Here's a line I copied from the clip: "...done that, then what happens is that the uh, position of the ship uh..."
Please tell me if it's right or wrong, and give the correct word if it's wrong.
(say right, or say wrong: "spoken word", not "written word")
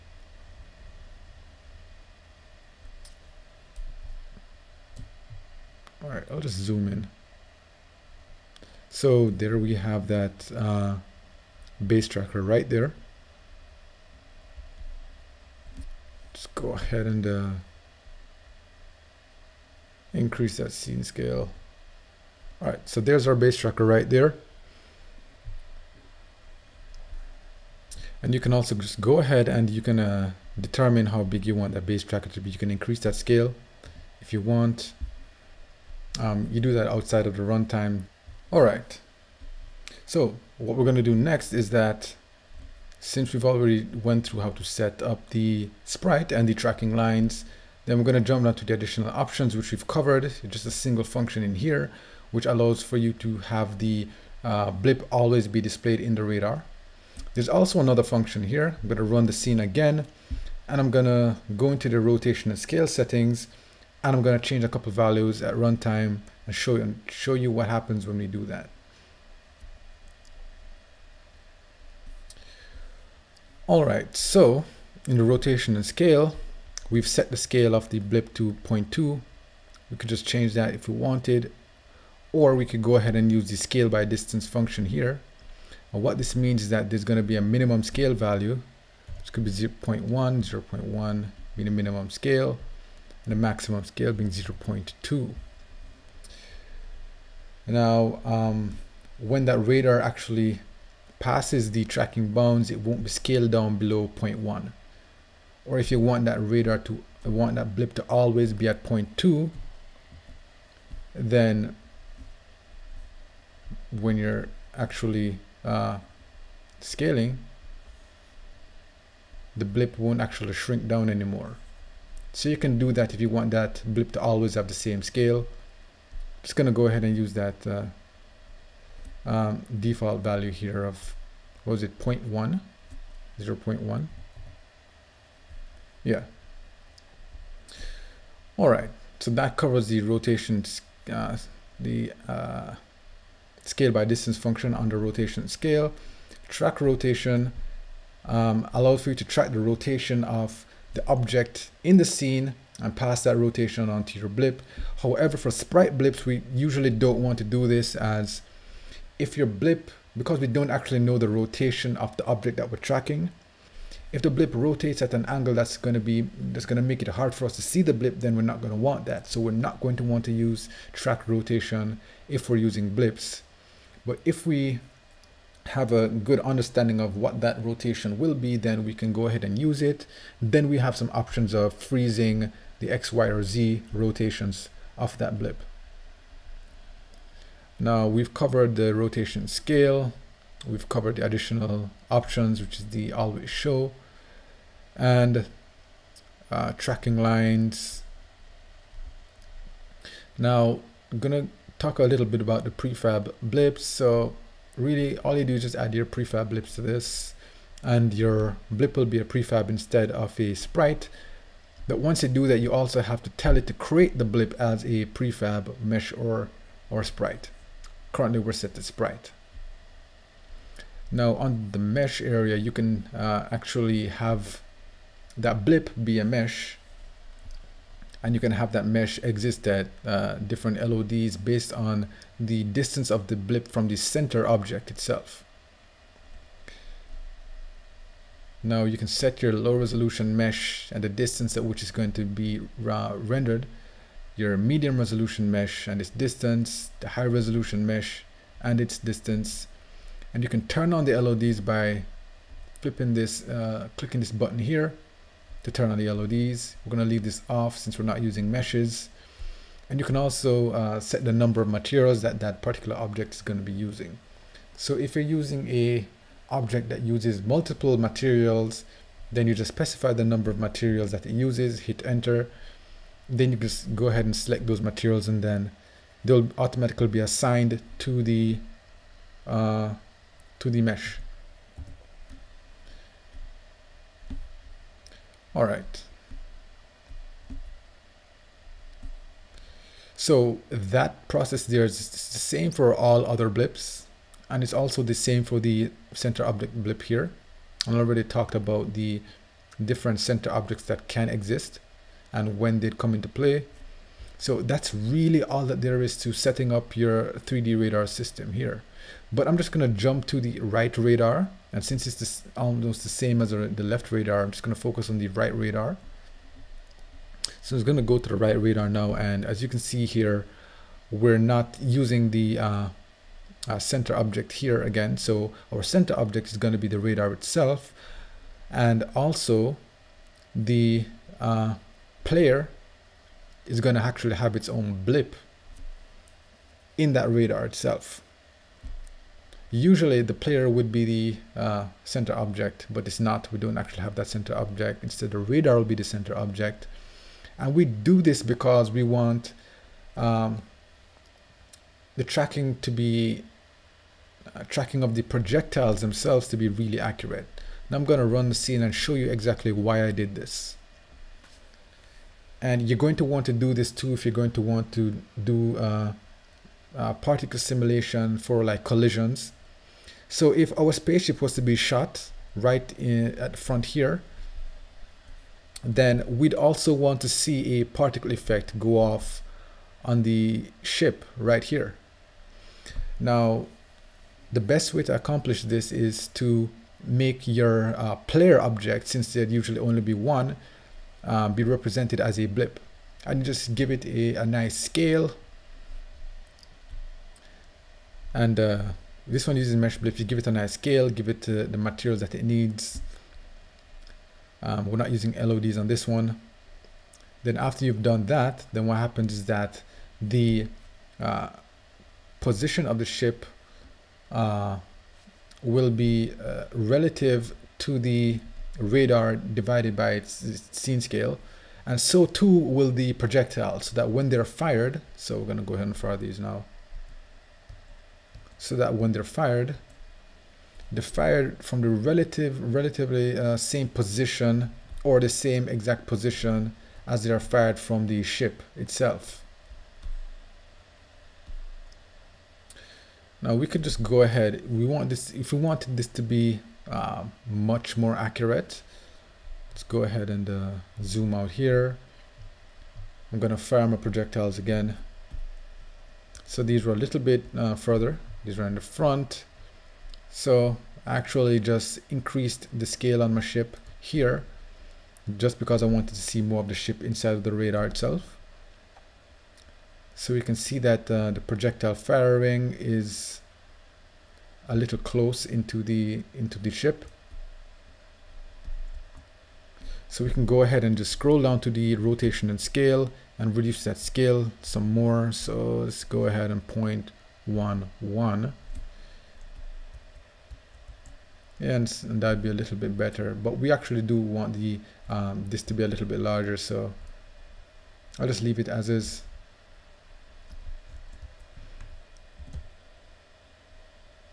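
right.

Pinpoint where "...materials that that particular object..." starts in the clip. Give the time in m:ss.
4:21.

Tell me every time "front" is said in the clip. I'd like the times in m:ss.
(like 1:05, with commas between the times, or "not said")
6:13, 7:38.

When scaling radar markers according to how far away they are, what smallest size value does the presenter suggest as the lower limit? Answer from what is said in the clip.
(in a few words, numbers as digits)
0.1.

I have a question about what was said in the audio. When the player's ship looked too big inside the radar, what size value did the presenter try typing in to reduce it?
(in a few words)
0.1.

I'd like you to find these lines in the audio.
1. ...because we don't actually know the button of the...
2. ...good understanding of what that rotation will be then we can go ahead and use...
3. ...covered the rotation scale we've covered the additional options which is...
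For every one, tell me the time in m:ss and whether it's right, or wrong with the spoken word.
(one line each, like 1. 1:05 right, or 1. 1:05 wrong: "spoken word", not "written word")
1. 2:40 wrong: "rotation", not "button"
2. 2:56 right
3. 3:08 right.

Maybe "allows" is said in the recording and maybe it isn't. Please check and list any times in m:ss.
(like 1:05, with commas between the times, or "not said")
0:52, 2:28.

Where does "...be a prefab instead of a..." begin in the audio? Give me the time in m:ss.
3:29.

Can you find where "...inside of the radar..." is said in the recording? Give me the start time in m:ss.
7:47.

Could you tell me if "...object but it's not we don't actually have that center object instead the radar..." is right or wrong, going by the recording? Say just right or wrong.
right.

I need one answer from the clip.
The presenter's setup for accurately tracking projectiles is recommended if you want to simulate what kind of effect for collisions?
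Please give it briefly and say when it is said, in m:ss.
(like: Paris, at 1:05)
particle simulation, at 6:07.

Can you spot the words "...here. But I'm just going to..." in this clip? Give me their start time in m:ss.
5:08.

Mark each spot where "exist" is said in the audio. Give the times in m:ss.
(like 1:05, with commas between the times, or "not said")
3:49, 5:01.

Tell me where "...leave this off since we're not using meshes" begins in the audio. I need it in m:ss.
4:17.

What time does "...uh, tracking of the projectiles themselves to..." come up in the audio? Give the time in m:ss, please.
5:54.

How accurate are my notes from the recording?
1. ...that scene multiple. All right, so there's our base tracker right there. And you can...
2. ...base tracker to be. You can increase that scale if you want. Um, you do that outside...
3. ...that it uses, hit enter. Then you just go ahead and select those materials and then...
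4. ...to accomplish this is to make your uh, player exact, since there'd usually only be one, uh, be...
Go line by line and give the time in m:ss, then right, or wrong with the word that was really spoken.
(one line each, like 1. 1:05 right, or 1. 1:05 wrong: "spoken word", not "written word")
1. 0:20 wrong: "scale", not "multiple"
2. 0:31 right
3. 4:31 right
4. 6:25 wrong: "object", not "exact".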